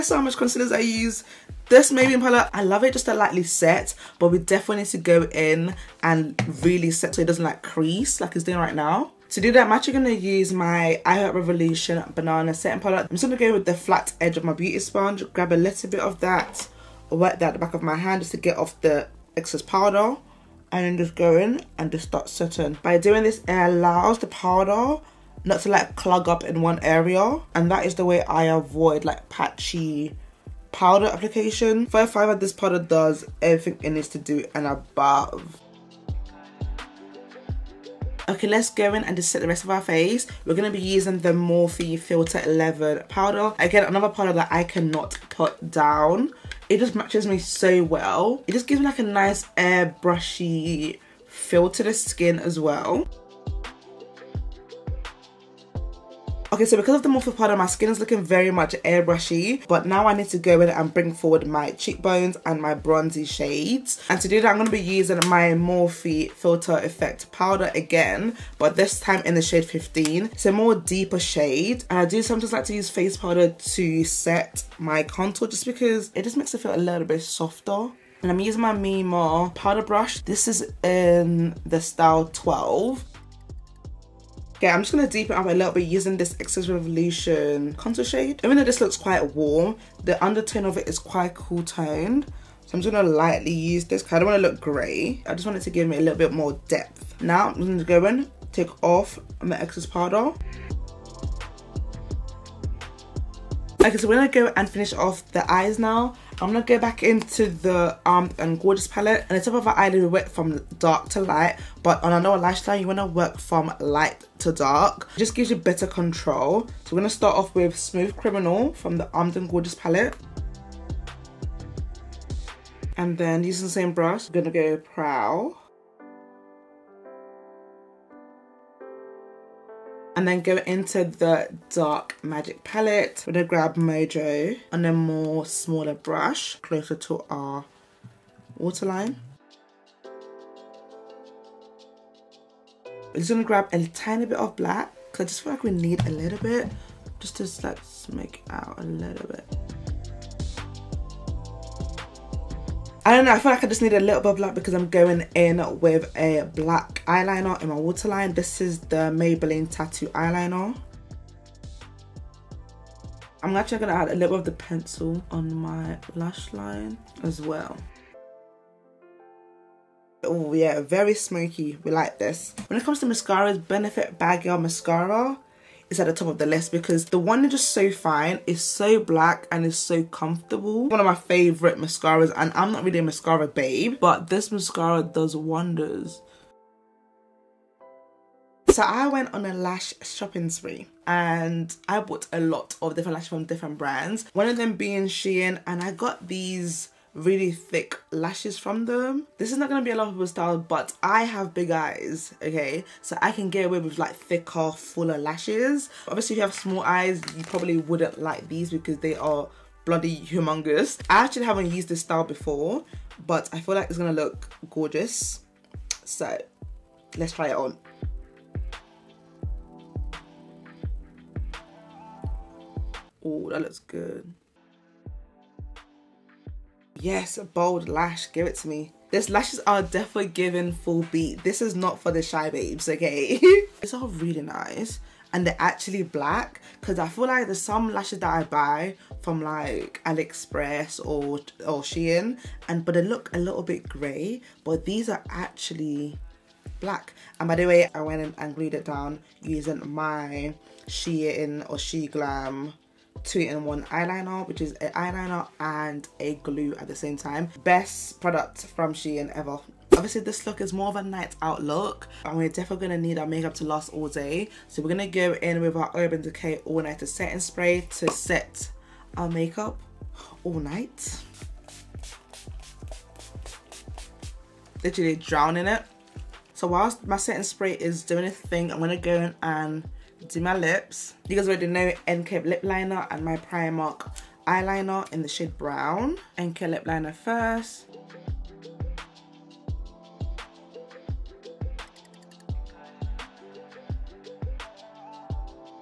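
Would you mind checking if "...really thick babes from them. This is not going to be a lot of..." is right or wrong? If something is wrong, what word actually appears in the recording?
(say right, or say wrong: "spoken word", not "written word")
wrong: "lashes", not "babes".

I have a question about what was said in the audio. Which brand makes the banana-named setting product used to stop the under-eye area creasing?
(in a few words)
I Heart Revolution.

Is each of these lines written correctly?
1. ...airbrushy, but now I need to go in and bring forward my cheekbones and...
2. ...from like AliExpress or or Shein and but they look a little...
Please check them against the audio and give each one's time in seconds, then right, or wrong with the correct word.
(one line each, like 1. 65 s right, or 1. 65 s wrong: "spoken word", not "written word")
1. 58 s right
2. 239 s right.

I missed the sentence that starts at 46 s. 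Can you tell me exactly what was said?
It just matches me so well.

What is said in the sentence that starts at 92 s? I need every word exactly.
So I'm just gonna lightly use this because I don't wanna look gray.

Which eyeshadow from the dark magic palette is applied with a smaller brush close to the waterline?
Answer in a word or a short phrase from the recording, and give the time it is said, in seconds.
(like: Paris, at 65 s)
Mojo, at 133 s.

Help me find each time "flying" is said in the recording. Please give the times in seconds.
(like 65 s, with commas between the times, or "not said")
not said.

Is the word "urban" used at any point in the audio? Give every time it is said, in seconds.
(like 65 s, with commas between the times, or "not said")
265 s.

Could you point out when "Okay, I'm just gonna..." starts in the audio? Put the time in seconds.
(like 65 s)
84 s.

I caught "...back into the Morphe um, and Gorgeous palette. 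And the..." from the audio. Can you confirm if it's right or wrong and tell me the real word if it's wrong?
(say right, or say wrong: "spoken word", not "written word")
wrong: "Armed", not "Morphe".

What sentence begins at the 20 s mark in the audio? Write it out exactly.
And then just go in and just start setting.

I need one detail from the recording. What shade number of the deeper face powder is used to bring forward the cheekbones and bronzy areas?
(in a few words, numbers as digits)
15.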